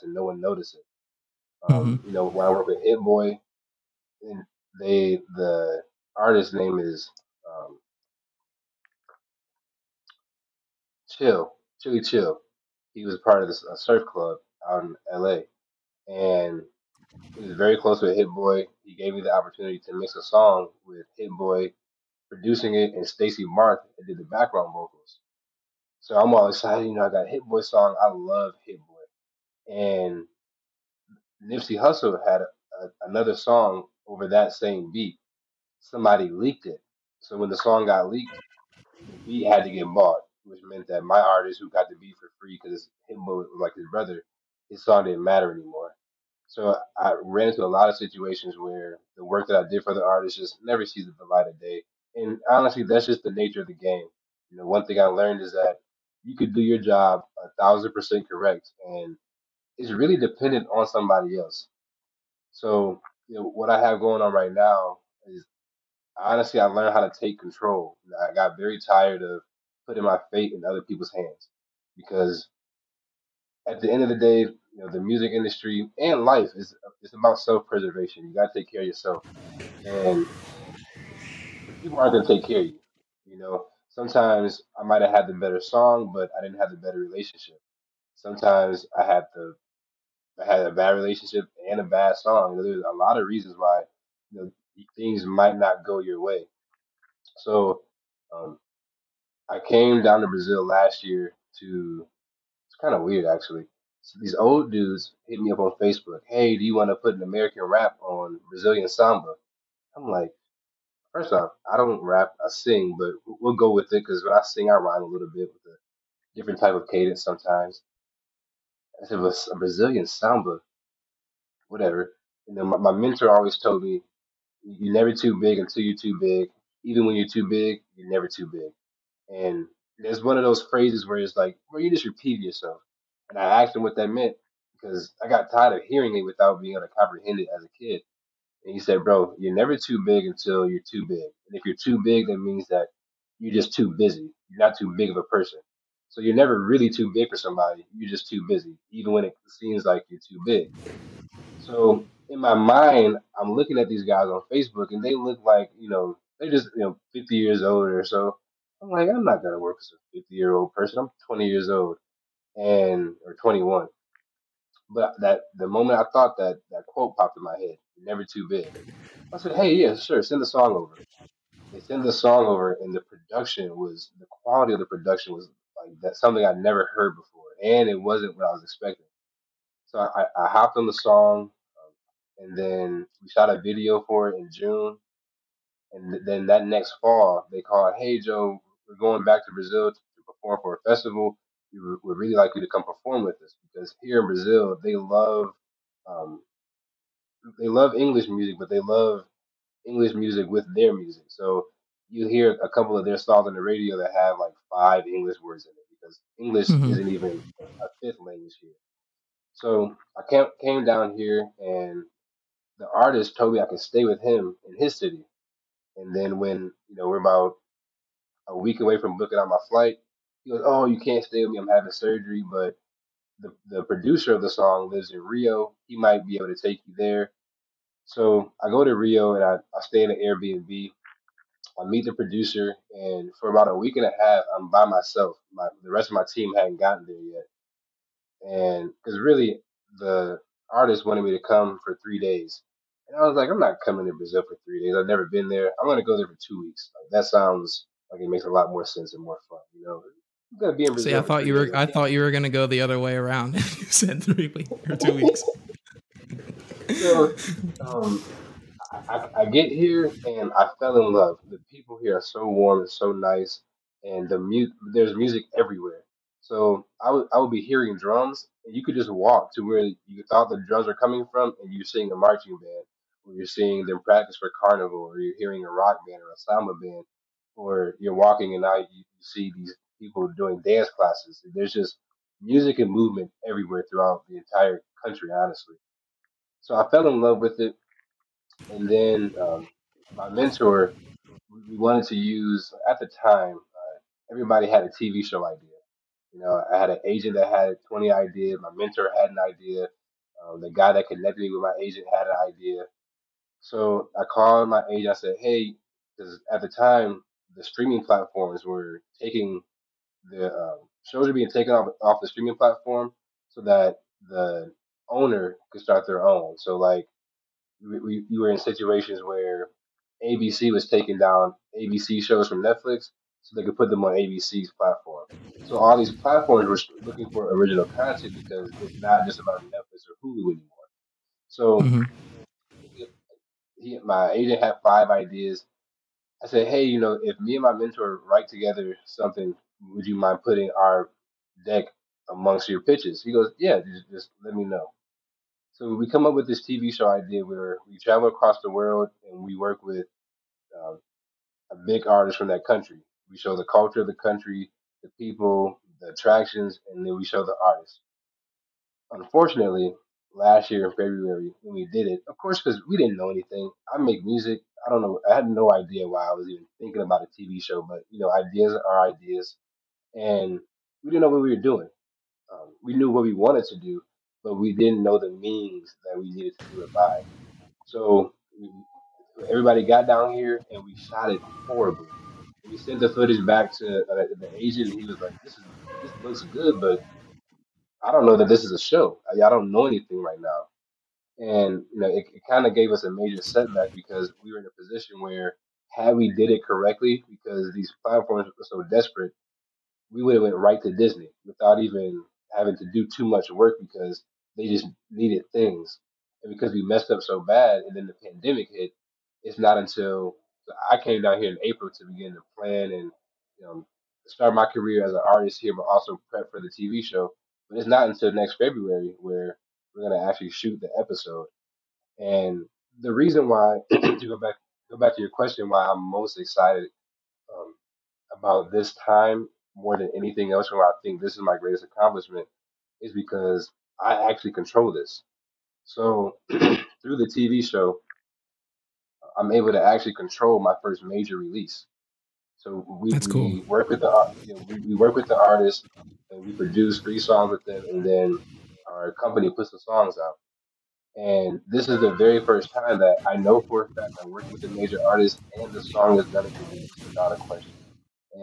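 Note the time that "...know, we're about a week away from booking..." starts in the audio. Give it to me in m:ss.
3:36.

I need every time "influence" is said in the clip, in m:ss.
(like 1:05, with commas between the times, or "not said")
not said.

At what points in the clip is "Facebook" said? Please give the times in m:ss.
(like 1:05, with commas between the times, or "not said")
1:45, 2:34.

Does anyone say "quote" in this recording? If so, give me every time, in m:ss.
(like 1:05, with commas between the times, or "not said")
2:46.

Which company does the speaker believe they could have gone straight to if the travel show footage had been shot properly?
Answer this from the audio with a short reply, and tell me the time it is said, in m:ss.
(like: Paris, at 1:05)
Disney, at 6:40.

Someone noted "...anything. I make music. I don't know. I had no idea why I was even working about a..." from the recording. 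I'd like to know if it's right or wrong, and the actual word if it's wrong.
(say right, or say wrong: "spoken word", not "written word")
wrong: "thinking", not "working".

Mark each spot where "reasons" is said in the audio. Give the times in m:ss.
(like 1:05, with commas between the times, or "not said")
1:33, 7:03.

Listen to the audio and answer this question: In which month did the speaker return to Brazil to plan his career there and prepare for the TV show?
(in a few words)
April.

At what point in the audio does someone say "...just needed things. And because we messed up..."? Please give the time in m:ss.
6:44.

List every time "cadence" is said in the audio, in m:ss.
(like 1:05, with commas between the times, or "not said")
1:56.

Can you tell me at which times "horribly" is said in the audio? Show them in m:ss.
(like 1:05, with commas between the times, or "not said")
6:21.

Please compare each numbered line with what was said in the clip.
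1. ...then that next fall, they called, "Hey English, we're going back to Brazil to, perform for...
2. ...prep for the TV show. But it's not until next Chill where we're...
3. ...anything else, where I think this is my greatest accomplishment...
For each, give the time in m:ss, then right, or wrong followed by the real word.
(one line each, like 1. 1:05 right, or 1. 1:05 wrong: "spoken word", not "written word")
1. 3:06 wrong: "Joe", not "English"
2. 6:56 wrong: "February", not "Chill"
3. 7:10 right.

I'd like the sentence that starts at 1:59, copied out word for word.
I said, a Brazilian samba, whatever.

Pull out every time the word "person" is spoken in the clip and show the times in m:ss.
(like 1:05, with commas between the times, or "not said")
2:25, 2:40.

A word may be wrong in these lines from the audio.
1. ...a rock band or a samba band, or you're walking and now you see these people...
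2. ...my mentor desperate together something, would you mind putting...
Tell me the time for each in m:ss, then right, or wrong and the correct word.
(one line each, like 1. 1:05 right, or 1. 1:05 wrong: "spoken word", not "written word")
1. 4:35 right
2. 5:37 wrong: "write", not "desperate".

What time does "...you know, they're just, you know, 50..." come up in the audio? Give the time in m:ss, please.
2:35.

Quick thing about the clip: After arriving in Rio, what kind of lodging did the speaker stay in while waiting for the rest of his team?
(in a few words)
Airbnb.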